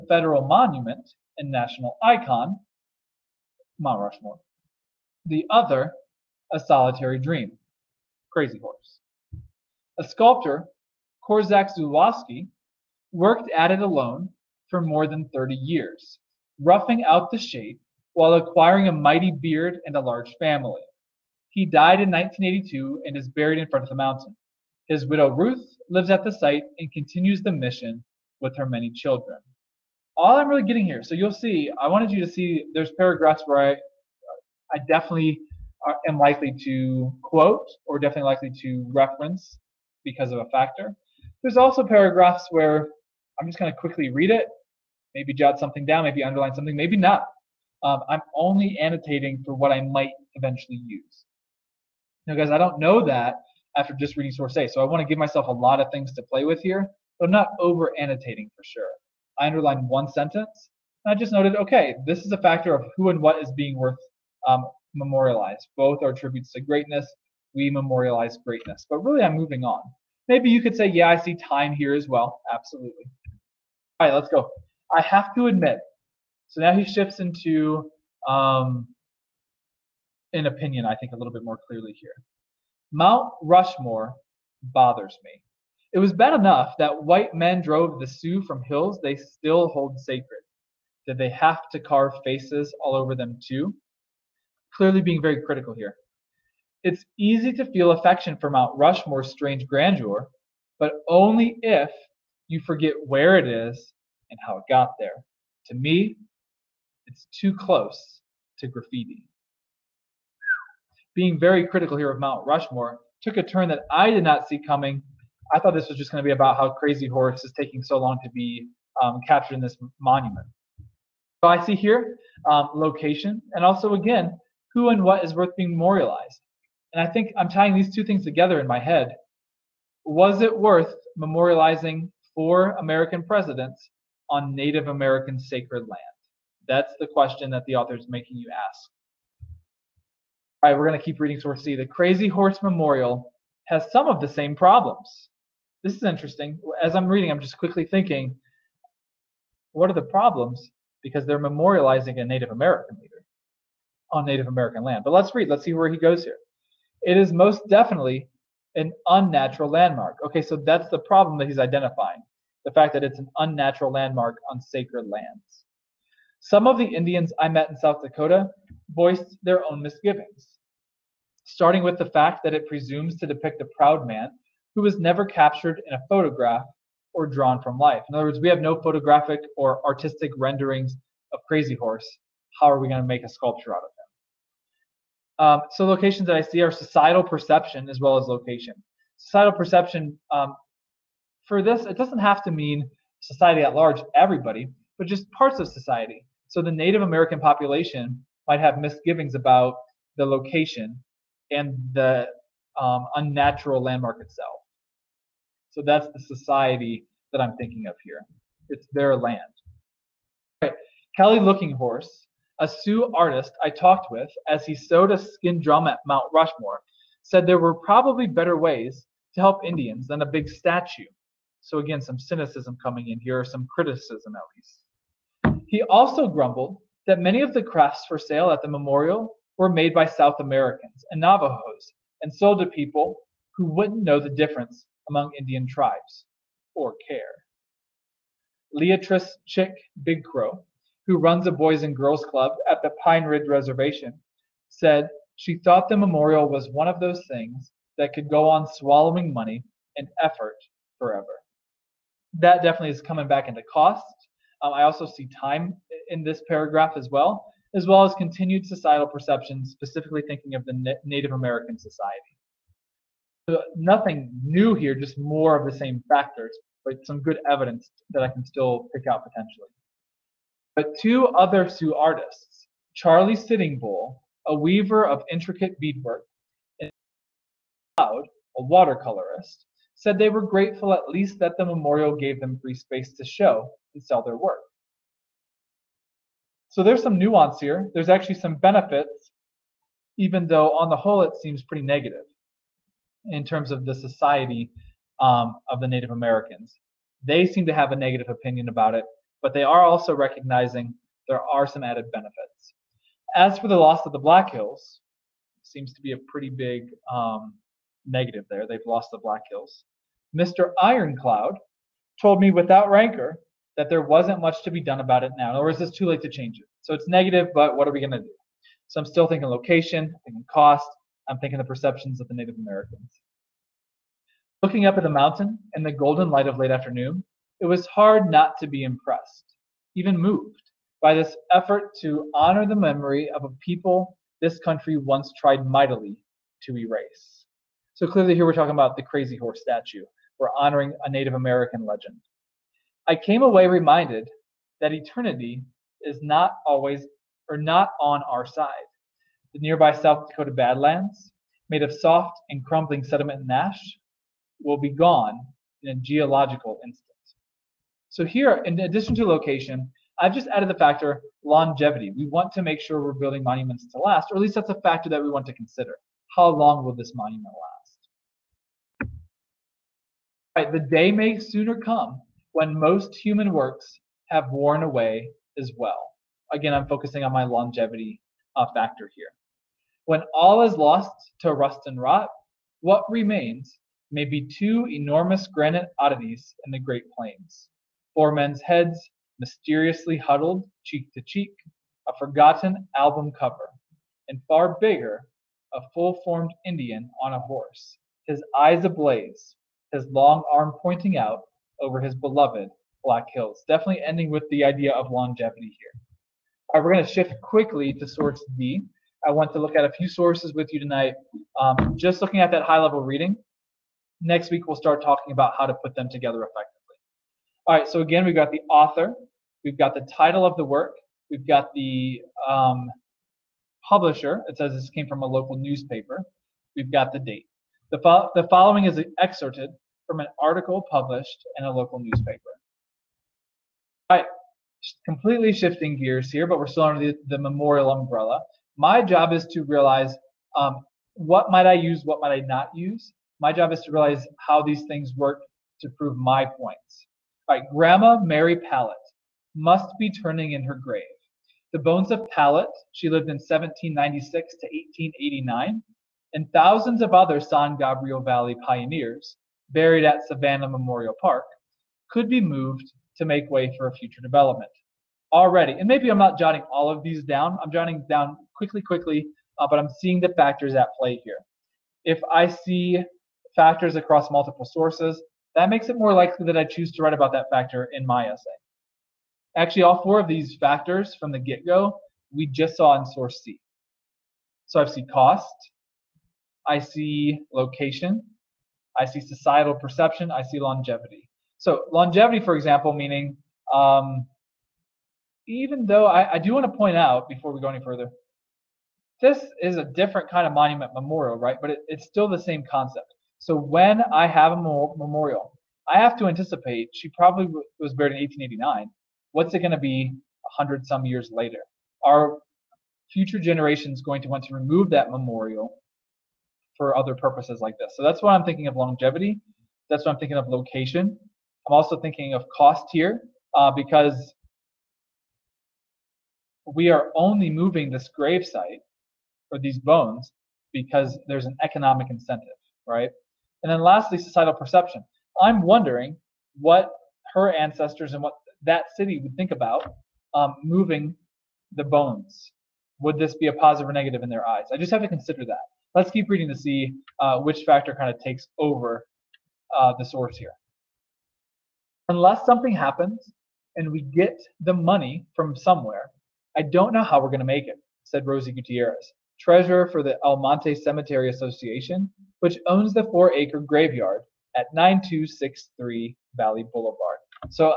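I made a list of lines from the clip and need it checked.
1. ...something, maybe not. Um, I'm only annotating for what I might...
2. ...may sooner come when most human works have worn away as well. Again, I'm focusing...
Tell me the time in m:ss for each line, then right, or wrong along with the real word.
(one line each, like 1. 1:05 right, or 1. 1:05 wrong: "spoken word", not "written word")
1. 0:46 right
2. 6:11 right.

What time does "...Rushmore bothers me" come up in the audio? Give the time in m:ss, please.
1:23.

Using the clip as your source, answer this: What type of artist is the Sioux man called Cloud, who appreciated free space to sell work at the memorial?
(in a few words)
watercolorist.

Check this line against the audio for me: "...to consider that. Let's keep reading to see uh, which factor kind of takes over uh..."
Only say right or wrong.
right.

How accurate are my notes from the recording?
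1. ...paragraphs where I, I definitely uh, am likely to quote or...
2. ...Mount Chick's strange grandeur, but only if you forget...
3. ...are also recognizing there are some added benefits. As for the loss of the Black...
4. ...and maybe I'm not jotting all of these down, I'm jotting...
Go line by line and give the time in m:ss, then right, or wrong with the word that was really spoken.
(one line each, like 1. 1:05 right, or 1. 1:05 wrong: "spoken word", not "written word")
1. 0:32 right
2. 1:38 wrong: "Rushmore", not "Chick"
3. 4:59 right
4. 7:45 right.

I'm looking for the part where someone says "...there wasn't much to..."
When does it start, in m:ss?
5:13.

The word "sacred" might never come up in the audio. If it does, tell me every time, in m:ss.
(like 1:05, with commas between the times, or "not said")
1:29, 2:15, 2:44.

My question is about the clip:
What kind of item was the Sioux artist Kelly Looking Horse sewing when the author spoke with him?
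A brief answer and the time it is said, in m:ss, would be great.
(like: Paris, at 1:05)
a skin drum, at 3:35.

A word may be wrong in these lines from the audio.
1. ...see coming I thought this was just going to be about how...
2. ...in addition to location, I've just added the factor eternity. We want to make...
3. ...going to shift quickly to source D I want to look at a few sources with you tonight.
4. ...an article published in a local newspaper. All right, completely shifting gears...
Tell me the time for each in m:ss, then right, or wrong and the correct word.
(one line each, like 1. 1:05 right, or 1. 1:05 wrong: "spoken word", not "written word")
1. 1:54 right
2. 5:58 wrong: "longevity", not "eternity"
3. 6:46 right
4. 7:10 right.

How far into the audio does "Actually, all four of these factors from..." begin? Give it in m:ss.
7:59.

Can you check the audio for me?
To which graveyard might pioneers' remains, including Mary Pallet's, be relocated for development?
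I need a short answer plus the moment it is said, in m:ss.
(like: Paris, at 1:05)
Savannah Memorial Park, at 7:40.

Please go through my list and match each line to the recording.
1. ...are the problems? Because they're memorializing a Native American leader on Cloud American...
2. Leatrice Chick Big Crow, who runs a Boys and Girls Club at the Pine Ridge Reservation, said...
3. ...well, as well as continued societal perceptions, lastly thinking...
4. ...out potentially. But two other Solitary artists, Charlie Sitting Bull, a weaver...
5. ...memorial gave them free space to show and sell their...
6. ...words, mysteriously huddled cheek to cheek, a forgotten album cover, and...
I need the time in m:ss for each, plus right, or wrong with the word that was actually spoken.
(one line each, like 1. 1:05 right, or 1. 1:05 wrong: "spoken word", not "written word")
1. 2:29 wrong: "Native", not "Cloud"
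2. 3:58 right
3. 4:17 wrong: "specifically", not "lastly"
4. 4:29 wrong: "Sioux", not "Solitary"
5. 4:41 right
6. 6:28 wrong: "heads", not "words".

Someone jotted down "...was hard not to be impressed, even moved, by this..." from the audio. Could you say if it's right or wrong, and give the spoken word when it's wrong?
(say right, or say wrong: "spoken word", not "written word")
right.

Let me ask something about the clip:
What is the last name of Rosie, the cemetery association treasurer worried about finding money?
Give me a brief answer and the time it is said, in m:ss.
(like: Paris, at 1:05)
Gutierrez, at 9:18.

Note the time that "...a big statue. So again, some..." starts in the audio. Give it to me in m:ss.
3:40.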